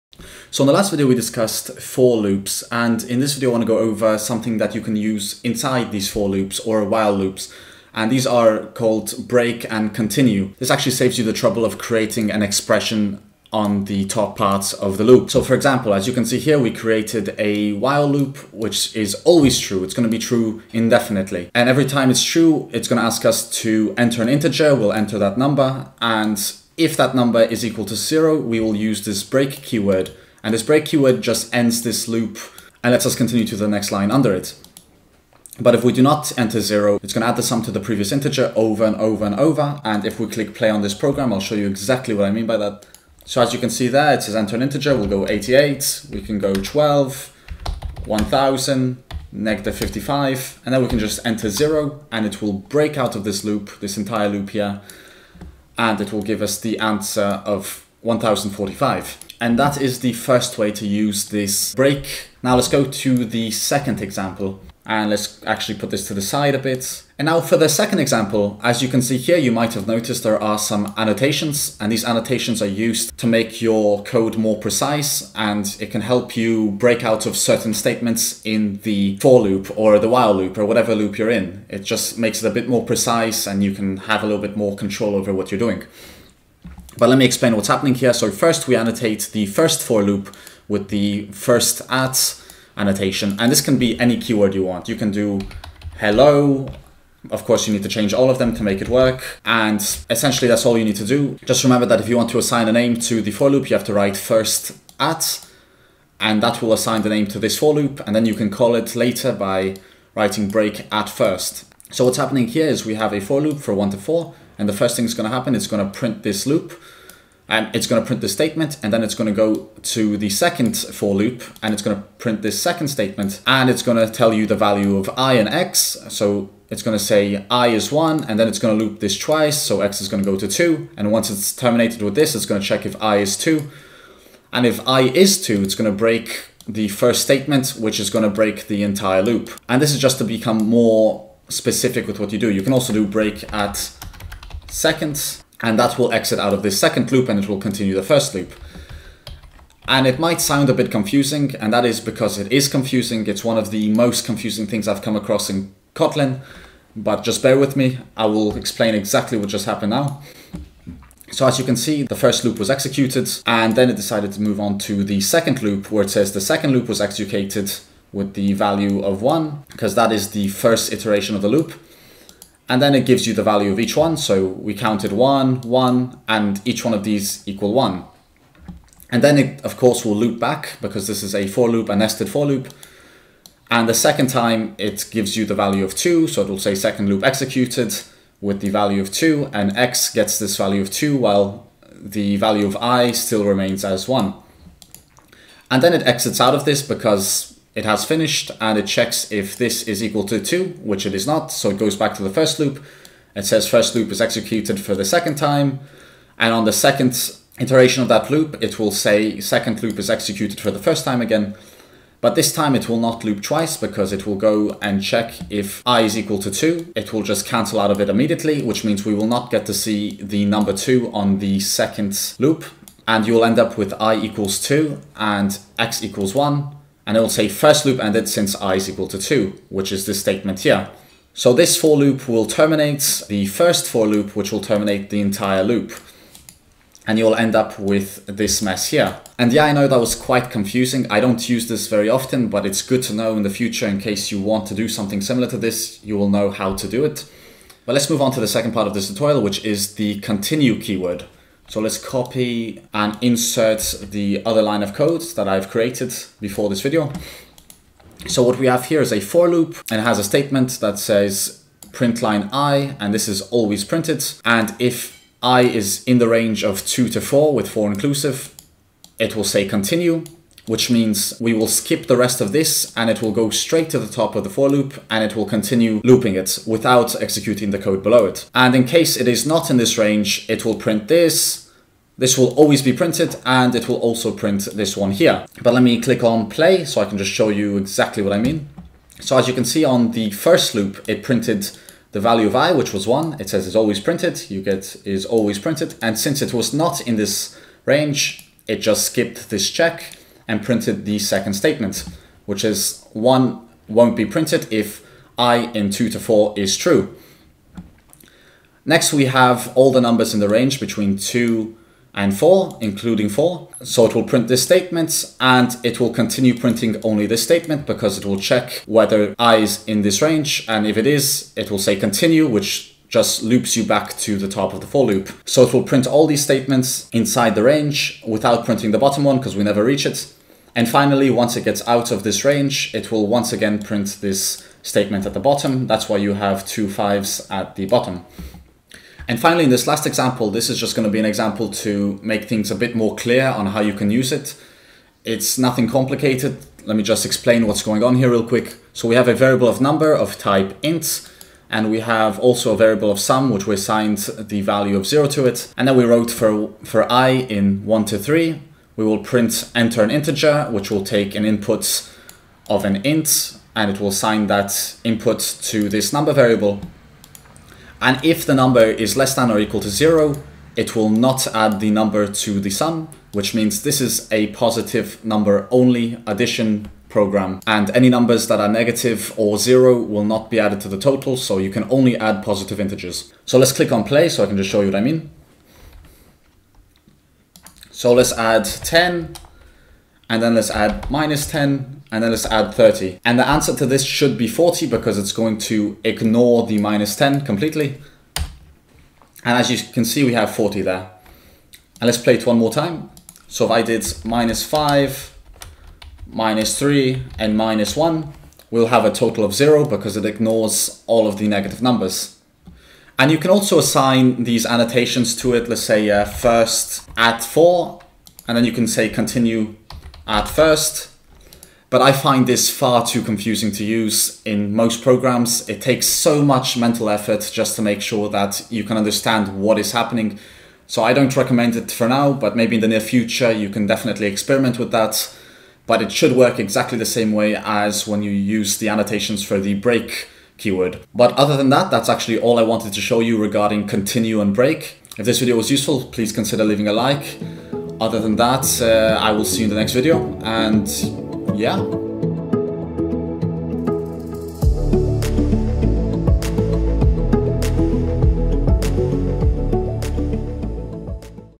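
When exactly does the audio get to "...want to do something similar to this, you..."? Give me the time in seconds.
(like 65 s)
244 s.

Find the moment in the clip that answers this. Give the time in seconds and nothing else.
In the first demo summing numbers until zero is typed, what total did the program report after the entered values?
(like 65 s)
58 s.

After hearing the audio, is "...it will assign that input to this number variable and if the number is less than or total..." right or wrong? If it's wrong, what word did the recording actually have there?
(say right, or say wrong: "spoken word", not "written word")
wrong: "equal", not "total".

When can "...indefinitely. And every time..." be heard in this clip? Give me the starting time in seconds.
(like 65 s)
20 s.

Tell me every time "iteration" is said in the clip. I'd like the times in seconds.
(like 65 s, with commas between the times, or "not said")
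170 s, 207 s.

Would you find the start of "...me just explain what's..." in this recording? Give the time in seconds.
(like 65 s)
346 s.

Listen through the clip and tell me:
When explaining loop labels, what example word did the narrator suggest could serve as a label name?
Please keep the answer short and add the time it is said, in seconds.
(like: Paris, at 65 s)
hello, at 95 s.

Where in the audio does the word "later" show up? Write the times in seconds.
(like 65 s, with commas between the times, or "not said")
108 s.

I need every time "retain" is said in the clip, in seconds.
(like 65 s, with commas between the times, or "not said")
not said.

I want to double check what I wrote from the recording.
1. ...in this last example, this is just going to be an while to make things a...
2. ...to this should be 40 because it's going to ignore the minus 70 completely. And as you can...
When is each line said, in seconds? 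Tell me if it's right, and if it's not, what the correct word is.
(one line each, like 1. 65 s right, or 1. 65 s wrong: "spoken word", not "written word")
1. 339 s wrong: "example", not "while"
2. 393 s wrong: "10", not "70".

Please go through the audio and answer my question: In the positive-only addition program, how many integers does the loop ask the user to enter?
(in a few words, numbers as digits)
3.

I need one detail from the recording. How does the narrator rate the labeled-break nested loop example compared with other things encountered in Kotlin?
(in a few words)
one of the most confusing.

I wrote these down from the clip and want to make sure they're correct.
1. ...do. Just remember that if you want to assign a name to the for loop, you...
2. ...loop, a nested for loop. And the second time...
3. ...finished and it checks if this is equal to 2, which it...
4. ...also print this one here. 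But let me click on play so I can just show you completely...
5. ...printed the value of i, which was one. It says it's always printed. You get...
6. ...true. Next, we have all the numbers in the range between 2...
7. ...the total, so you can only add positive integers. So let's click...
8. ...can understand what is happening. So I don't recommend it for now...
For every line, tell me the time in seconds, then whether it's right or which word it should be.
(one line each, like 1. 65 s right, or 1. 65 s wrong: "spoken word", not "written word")
1. 101 s right
2. 181 s right
3. 198 s right
4. 283 s wrong: "exactly", not "completely"
5. 291 s right
6. 306 s right
7. 380 s right
8. 428 s right.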